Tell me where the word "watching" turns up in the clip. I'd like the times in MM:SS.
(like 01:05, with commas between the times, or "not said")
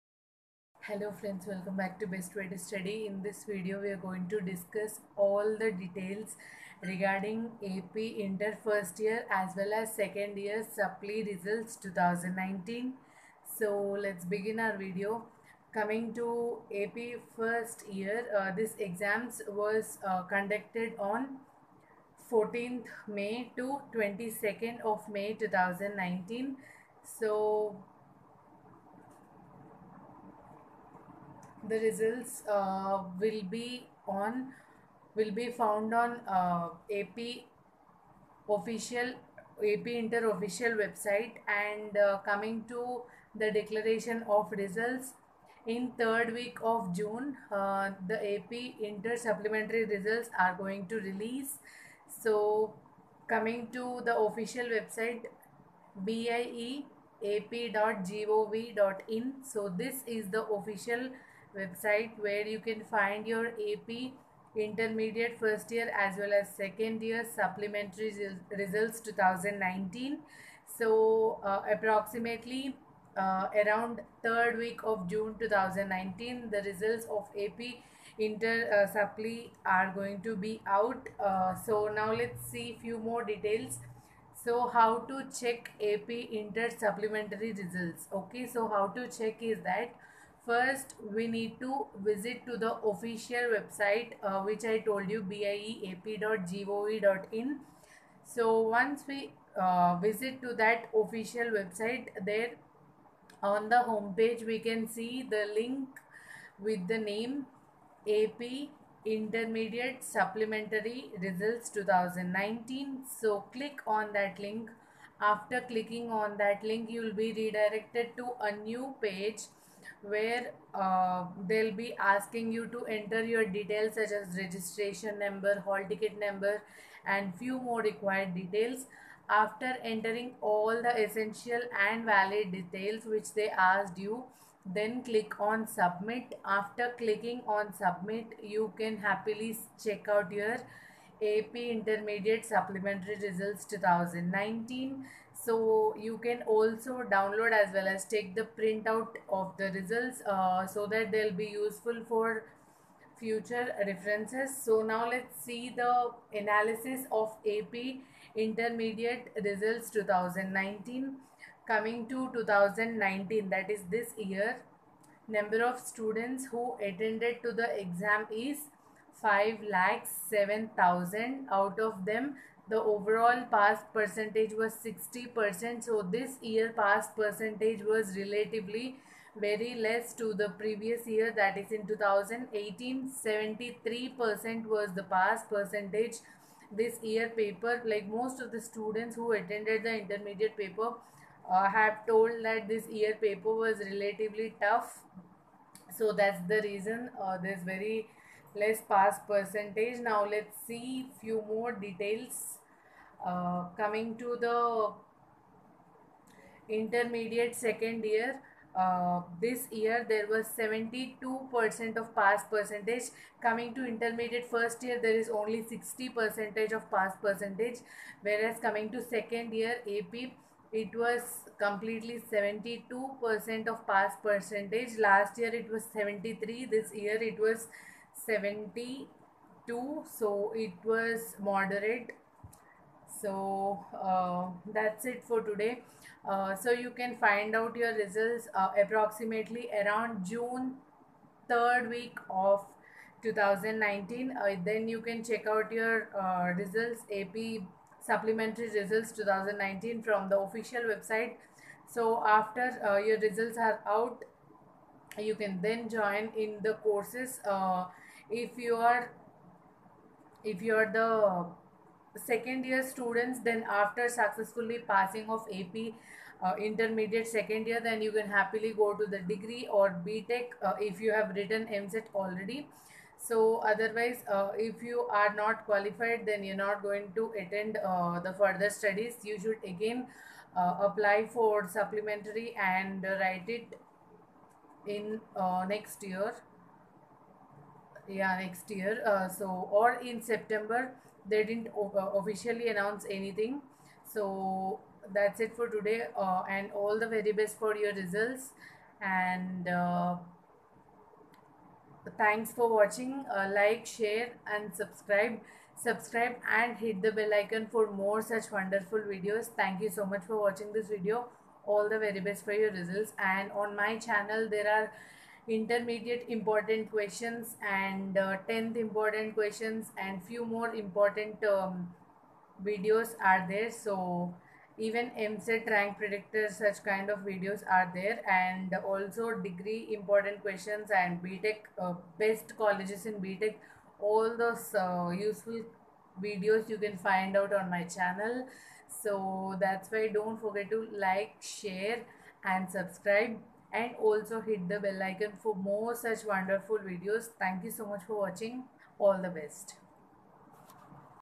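05:02, 05:10, 05:48.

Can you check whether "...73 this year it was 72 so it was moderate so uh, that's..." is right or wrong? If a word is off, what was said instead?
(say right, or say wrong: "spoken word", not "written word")
right.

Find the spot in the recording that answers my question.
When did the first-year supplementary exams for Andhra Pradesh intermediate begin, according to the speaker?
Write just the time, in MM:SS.
00:22.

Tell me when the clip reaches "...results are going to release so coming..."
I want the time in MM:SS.
00:49.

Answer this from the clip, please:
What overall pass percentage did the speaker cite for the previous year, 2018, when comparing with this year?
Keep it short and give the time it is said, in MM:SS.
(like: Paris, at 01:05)
73%, at 03:01.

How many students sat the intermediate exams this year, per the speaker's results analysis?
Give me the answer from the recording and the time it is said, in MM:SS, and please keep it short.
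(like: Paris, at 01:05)
5 lakhs 7000, at 02:49.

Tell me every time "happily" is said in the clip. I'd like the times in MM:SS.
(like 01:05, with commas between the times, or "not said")
02:18, 04:28.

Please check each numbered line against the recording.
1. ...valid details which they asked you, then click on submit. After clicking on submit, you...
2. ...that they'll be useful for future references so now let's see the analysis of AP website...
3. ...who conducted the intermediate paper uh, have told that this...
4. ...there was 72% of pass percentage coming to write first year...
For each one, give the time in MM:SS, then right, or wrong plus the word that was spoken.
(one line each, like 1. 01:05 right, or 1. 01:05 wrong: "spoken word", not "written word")
1. 02:12 right
2. 02:30 wrong: "intermediate", not "website"
3. 03:09 wrong: "attended", not "conducted"
4. 03:30 wrong: "intermediate", not "write".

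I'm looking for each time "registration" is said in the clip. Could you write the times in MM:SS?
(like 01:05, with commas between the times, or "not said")
02:04.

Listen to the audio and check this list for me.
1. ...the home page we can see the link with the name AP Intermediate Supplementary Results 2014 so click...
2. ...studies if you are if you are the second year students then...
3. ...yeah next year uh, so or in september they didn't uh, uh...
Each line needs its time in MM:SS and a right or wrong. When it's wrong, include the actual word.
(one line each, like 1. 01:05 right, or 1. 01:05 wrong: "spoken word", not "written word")
1. 01:43 wrong: "2019", not "2014"
2. 04:16 wrong: "courses", not "studies"
3. 04:48 right.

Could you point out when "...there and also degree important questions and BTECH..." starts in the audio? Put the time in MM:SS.
05:27.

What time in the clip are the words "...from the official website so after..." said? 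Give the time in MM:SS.
04:10.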